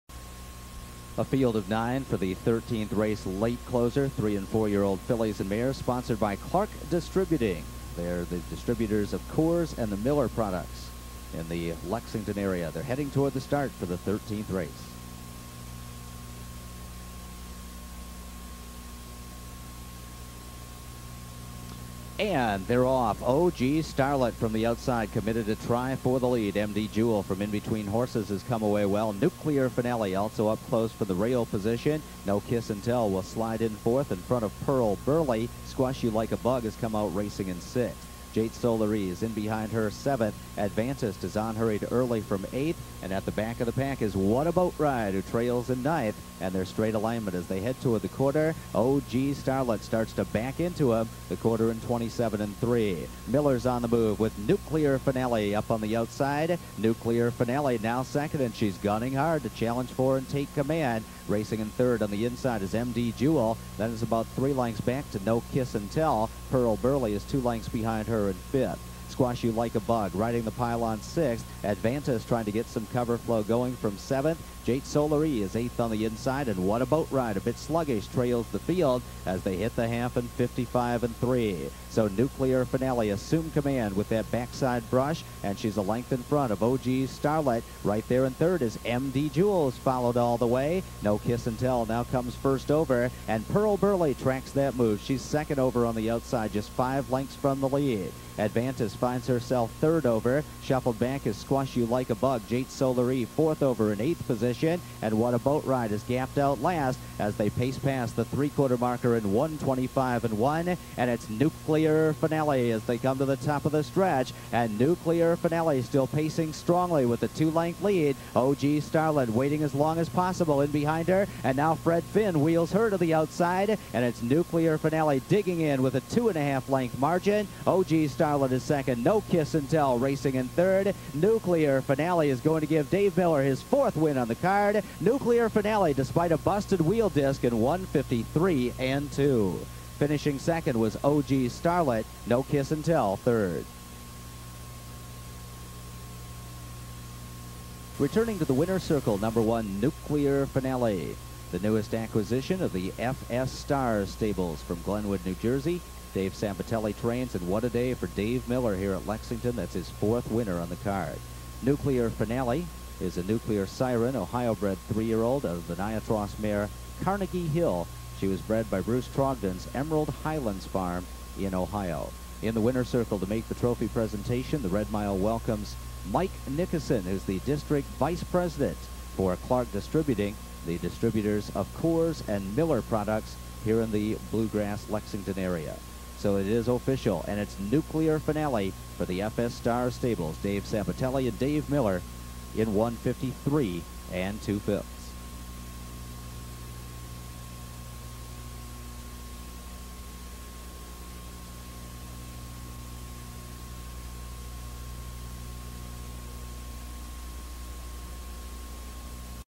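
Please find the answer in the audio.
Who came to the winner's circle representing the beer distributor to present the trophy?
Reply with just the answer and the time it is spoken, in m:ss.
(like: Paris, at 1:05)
Mike Nickerson, at 2:56.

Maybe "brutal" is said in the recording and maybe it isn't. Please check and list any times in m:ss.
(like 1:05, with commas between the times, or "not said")
not said.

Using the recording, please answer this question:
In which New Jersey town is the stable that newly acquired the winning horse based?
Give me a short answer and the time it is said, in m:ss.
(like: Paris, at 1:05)
Glenwood, at 2:34.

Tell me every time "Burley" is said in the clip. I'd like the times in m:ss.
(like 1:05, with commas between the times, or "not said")
0:35, 1:06, 1:33.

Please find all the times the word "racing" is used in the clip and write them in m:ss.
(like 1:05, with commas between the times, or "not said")
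0:37, 1:01, 2:09.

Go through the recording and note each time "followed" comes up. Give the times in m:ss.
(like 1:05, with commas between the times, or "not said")
1:29.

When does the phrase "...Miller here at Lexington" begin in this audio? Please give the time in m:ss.
2:38.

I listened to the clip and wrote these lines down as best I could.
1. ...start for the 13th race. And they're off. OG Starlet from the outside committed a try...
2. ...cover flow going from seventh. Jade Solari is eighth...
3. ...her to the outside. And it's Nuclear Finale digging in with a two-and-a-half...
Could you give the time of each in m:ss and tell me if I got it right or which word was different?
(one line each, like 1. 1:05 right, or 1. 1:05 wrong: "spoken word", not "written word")
1. 0:13 right
2. 1:12 right
3. 2:02 right.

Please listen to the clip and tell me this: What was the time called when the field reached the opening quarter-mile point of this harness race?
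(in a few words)
27 and 3.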